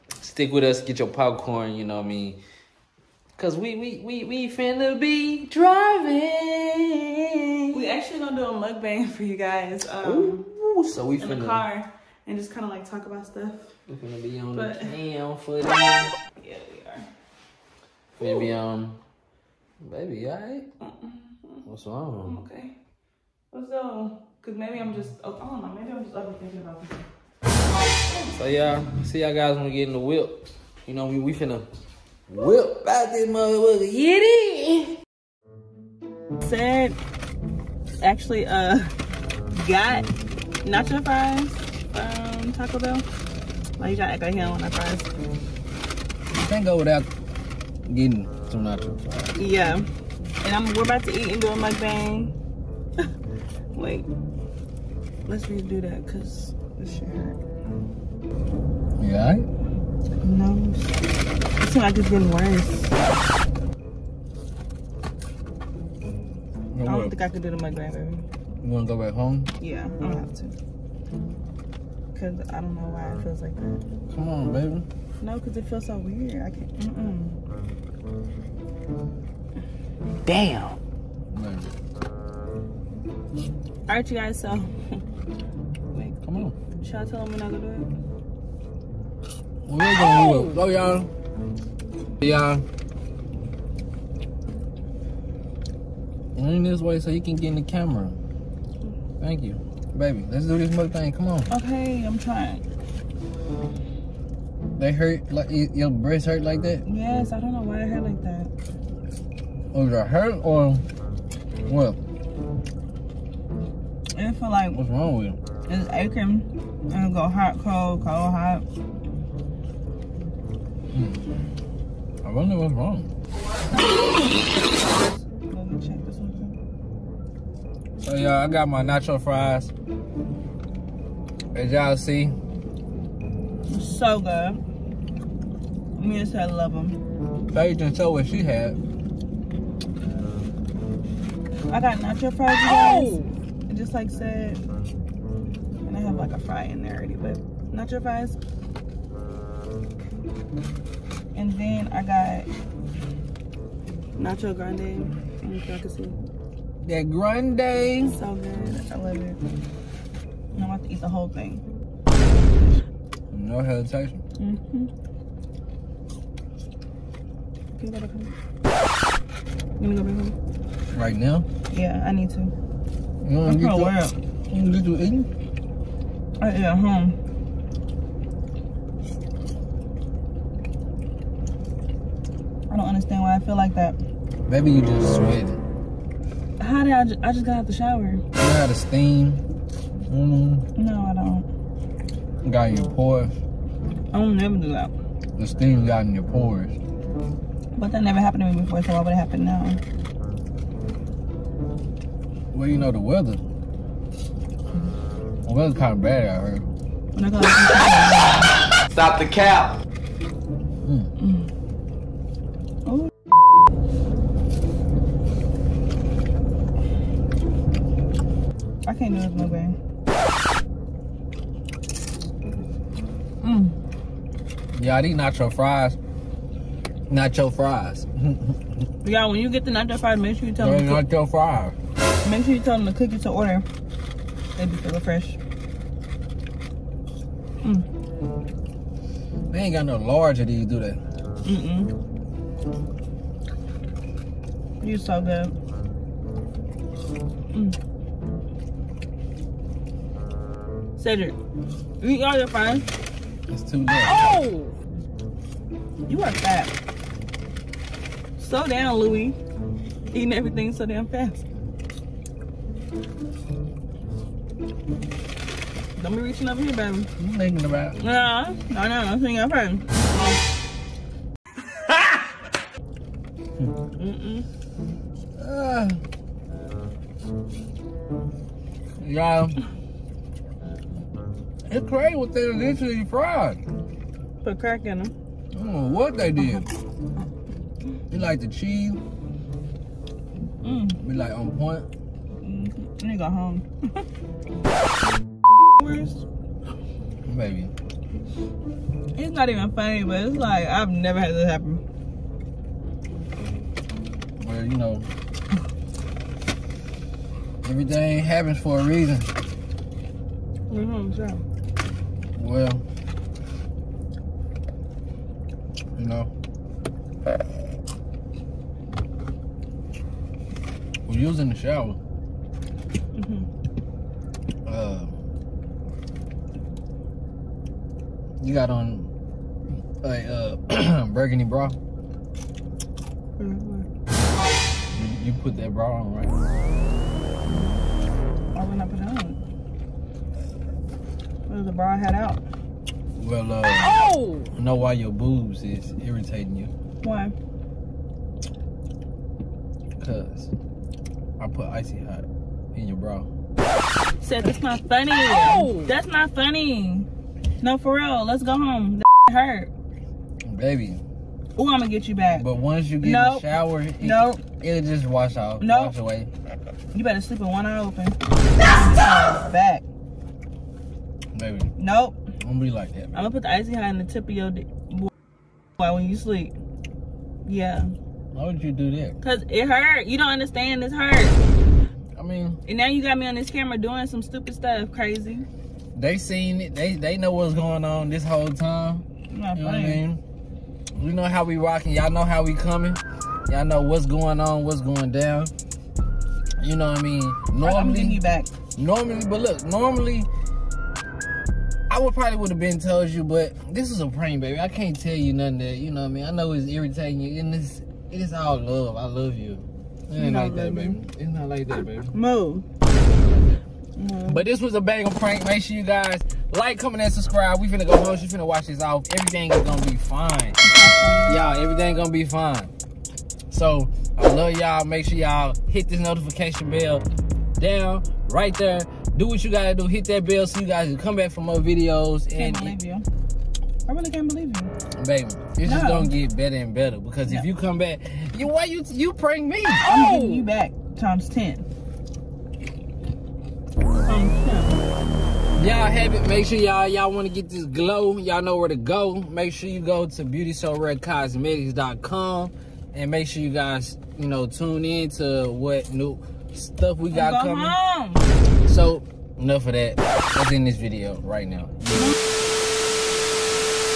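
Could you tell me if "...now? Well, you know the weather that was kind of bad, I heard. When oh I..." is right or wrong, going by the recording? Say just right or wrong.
right.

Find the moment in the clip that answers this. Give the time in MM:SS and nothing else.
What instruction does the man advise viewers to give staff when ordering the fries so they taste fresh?
03:52.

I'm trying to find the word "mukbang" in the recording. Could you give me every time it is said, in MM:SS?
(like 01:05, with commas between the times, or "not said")
00:08, 00:51.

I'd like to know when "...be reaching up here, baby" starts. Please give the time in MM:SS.
04:26.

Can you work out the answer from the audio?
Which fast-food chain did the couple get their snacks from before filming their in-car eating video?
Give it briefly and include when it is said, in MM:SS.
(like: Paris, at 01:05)
Taco Bell, at 00:42.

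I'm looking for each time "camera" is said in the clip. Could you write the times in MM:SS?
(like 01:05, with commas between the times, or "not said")
01:37, 06:23.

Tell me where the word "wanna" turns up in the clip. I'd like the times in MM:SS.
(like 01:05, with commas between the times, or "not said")
01:08, 02:54.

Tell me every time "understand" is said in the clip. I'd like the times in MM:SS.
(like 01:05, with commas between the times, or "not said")
03:02, 06:20.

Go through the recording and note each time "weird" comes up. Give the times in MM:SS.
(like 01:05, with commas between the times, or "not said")
01:15.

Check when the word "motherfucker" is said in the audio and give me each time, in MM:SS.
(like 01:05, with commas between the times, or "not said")
00:33.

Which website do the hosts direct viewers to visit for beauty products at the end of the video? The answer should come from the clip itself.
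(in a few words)
beautysorarecosmetics.com.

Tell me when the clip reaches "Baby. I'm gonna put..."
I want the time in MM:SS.
06:12.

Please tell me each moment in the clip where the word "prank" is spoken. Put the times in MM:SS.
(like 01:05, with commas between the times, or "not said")
06:44, 06:55, 07:19.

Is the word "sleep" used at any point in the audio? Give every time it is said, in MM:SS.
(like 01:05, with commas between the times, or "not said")
06:07, 06:16.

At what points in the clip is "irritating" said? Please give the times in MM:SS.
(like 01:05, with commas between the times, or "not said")
05:46, 06:46.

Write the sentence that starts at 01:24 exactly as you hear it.
So should I tell him we're not gonna do it?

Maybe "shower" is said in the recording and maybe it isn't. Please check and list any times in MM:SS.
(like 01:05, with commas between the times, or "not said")
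03:07, 05:21, 06:03.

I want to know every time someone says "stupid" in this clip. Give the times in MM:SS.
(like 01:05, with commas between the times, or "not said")
06:24.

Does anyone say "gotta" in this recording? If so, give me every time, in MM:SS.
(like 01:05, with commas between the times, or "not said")
00:43, 02:47, 07:09.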